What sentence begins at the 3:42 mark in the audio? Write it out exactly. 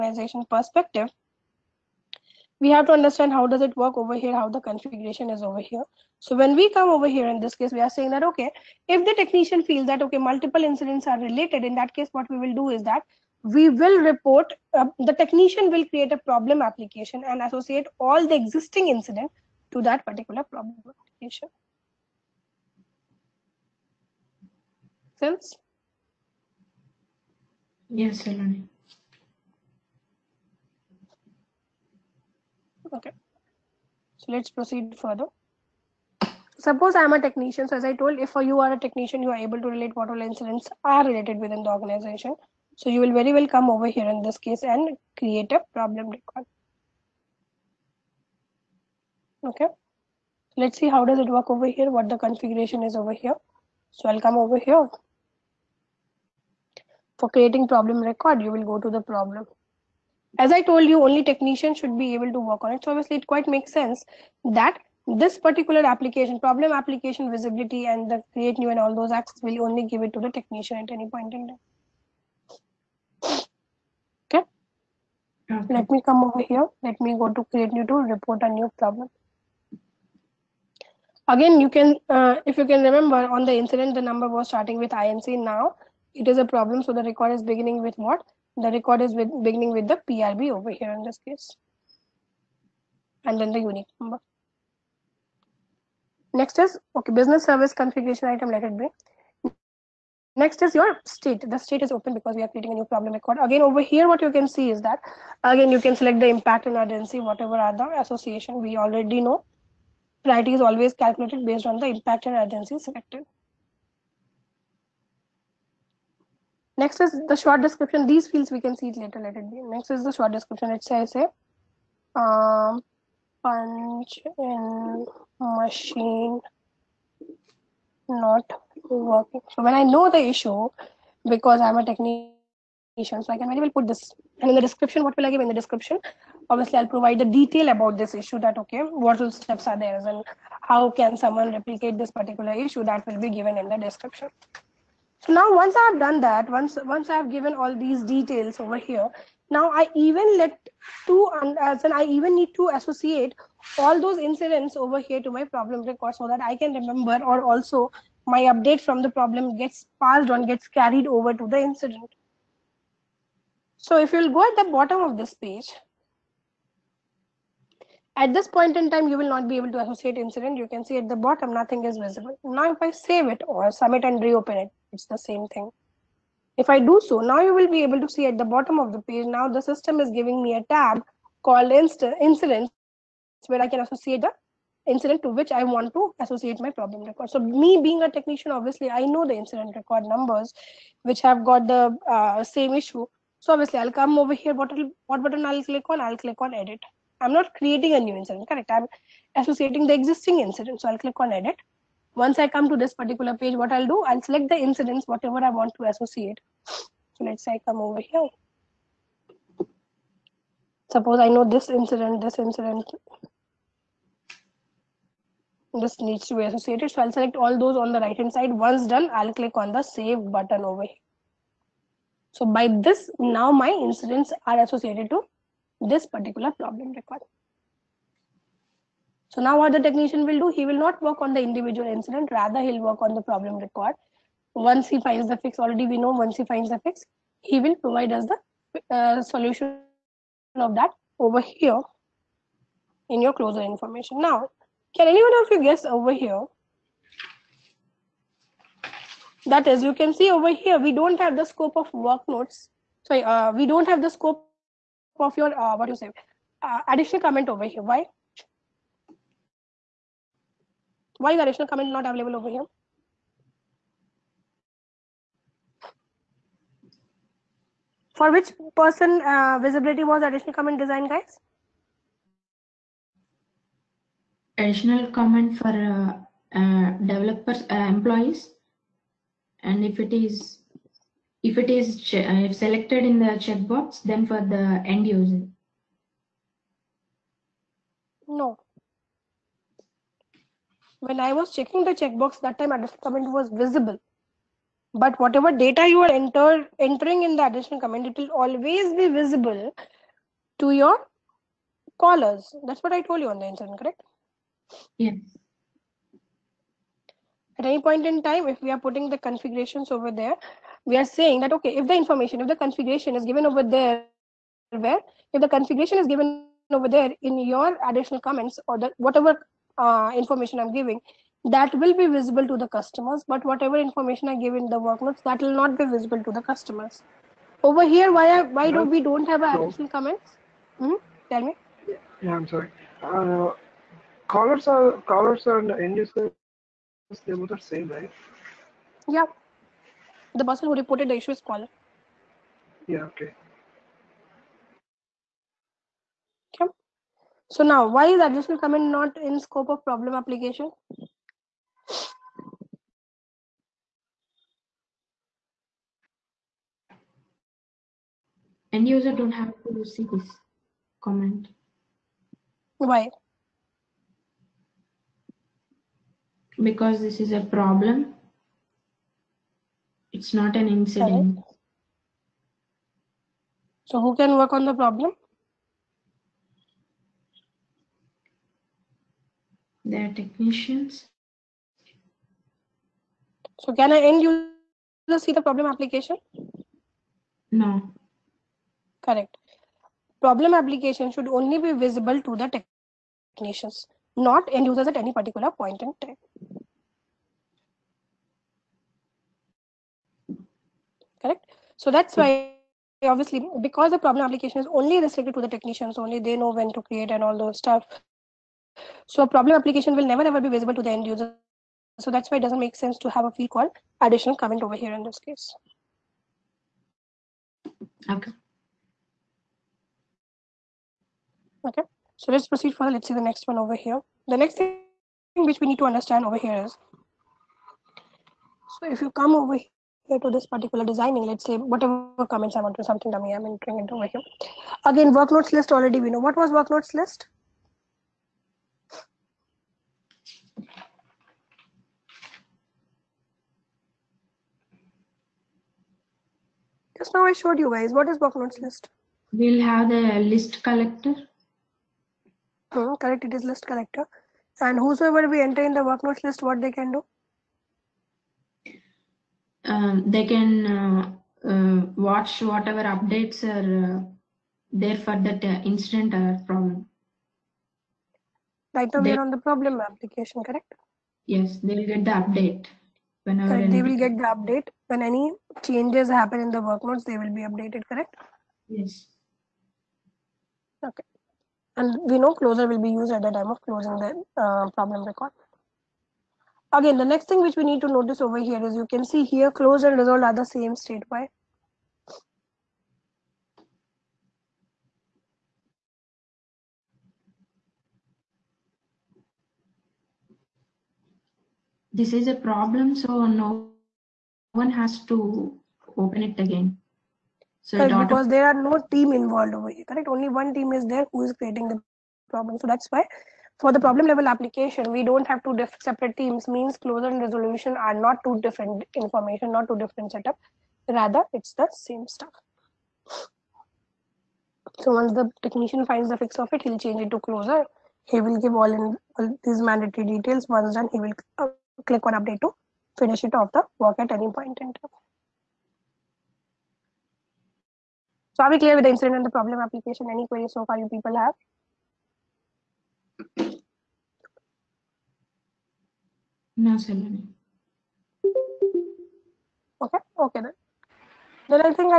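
So by this, now my incidents are associated to this particular problem record.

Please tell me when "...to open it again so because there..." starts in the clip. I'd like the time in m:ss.
8:25.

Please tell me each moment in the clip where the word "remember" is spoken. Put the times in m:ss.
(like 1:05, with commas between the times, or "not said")
1:22, 2:36.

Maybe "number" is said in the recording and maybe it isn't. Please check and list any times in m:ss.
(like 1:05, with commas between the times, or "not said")
1:24, 1:33, 3:10.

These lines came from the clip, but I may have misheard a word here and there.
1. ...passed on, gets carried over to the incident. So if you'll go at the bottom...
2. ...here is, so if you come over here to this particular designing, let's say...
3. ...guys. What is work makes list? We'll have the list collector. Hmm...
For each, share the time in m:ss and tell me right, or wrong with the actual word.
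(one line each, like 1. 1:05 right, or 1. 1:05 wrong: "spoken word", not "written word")
1. 2:40 right
2. 7:06 right
3. 7:27 wrong: "notes", not "makes".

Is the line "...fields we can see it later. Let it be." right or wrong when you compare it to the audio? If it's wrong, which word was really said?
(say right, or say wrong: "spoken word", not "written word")
right.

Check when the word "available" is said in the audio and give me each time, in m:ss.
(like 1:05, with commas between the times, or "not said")
4:22.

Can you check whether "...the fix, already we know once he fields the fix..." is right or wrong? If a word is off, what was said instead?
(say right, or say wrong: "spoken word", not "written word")
wrong: "finds", not "fields".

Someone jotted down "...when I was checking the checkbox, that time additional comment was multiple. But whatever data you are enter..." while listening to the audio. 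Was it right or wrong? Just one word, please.
wrong.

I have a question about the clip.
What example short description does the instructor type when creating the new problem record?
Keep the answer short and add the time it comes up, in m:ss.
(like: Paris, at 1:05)
punch in machine not working, at 2:03.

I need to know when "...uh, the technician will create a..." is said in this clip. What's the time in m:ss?
0:14.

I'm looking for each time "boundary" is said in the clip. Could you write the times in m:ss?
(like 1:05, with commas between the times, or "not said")
not said.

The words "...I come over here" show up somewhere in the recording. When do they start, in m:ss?
3:27.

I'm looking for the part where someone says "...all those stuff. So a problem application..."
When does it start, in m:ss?
6:47.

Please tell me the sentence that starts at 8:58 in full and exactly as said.
So are we clear with the incident and the problem application?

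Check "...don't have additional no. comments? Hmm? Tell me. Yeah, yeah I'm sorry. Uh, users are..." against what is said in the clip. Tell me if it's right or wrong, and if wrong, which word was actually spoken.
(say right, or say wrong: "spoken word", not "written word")
wrong: "callers", not "users".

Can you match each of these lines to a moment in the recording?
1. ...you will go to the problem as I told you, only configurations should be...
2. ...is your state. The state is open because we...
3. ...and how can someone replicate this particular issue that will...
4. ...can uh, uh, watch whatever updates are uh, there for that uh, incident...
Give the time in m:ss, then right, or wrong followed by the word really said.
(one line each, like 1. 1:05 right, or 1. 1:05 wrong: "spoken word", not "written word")
1. 0:58 wrong: "technicians", not "configurations"
2. 1:40 right
3. 2:20 right
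4. 7:40 right.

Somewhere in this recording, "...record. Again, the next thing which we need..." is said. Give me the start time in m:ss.
8:05.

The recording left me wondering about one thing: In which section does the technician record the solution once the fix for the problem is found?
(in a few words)
closure information.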